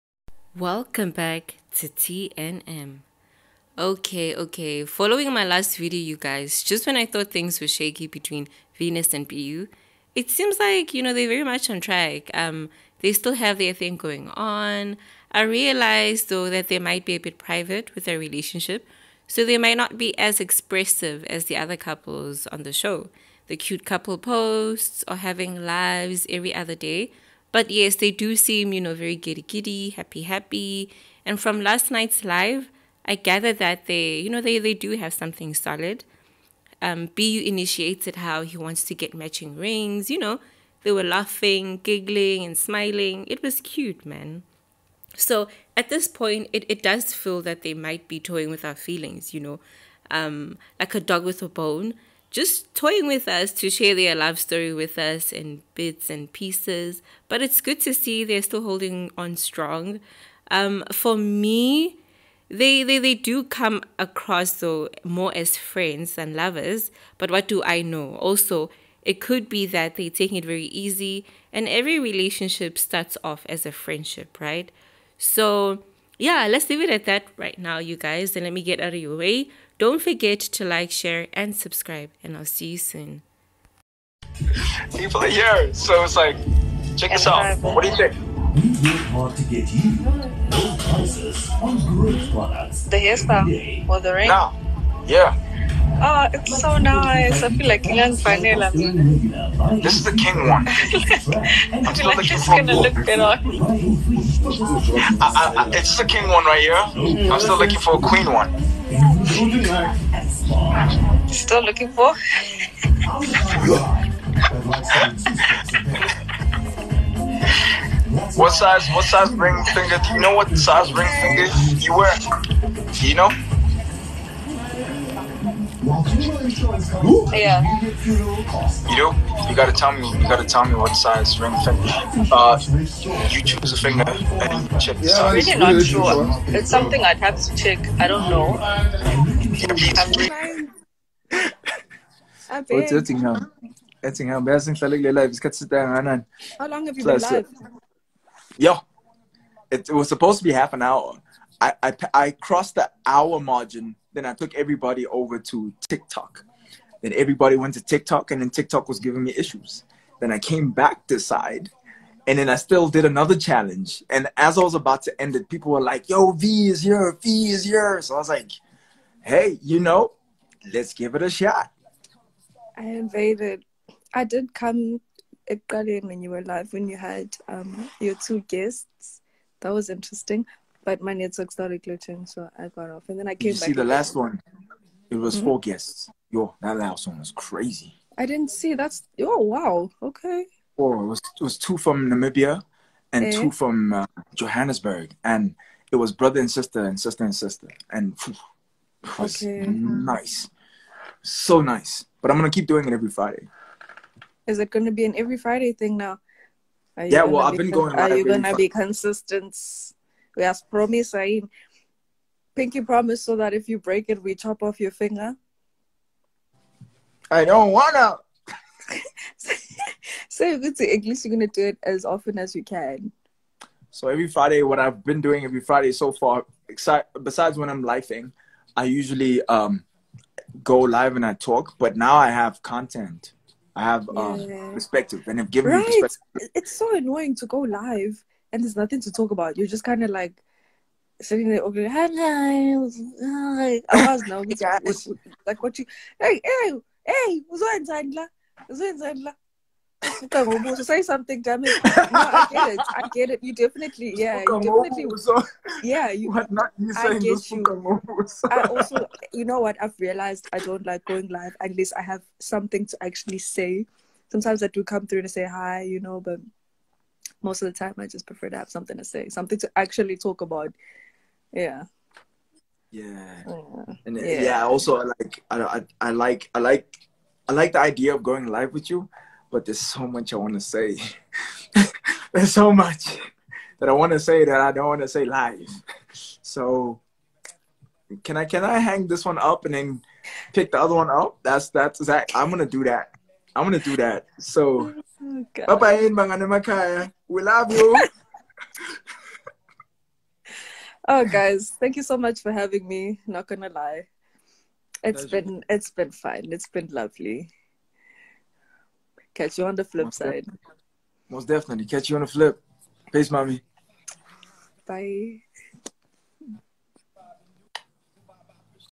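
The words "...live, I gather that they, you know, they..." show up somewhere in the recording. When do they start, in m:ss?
0:32.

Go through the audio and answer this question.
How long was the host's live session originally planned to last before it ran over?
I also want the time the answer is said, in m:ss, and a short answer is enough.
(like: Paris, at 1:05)
Half an hour, at 2:30.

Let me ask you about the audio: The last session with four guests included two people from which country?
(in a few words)
Namibia.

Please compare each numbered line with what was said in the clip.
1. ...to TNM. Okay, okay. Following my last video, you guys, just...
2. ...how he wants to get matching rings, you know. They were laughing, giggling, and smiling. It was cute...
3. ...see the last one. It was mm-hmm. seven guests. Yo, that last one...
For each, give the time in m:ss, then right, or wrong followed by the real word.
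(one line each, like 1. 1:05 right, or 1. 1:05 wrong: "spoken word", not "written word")
1. 0:01 right
2. 0:38 right
3. 3:03 wrong: "four", not "seven".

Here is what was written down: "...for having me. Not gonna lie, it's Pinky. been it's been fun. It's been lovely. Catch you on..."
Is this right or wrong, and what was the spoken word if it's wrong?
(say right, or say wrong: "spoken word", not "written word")
wrong: "Pleasure", not "Pinky".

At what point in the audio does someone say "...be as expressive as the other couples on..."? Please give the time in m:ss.
0:19.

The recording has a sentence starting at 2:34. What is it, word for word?
Then I took everybody over to TikTok.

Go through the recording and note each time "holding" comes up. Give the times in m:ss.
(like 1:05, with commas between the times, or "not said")
0:58.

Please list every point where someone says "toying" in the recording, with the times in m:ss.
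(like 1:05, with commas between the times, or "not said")
0:48, 0:52.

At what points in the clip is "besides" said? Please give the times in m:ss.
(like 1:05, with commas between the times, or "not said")
3:47.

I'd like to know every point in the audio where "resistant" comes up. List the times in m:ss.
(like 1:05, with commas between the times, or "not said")
not said.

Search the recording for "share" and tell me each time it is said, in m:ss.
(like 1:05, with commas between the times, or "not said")
0:53, 1:20.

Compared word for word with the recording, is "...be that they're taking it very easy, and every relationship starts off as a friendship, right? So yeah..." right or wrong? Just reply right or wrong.
right.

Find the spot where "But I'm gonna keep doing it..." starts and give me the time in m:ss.
3:22.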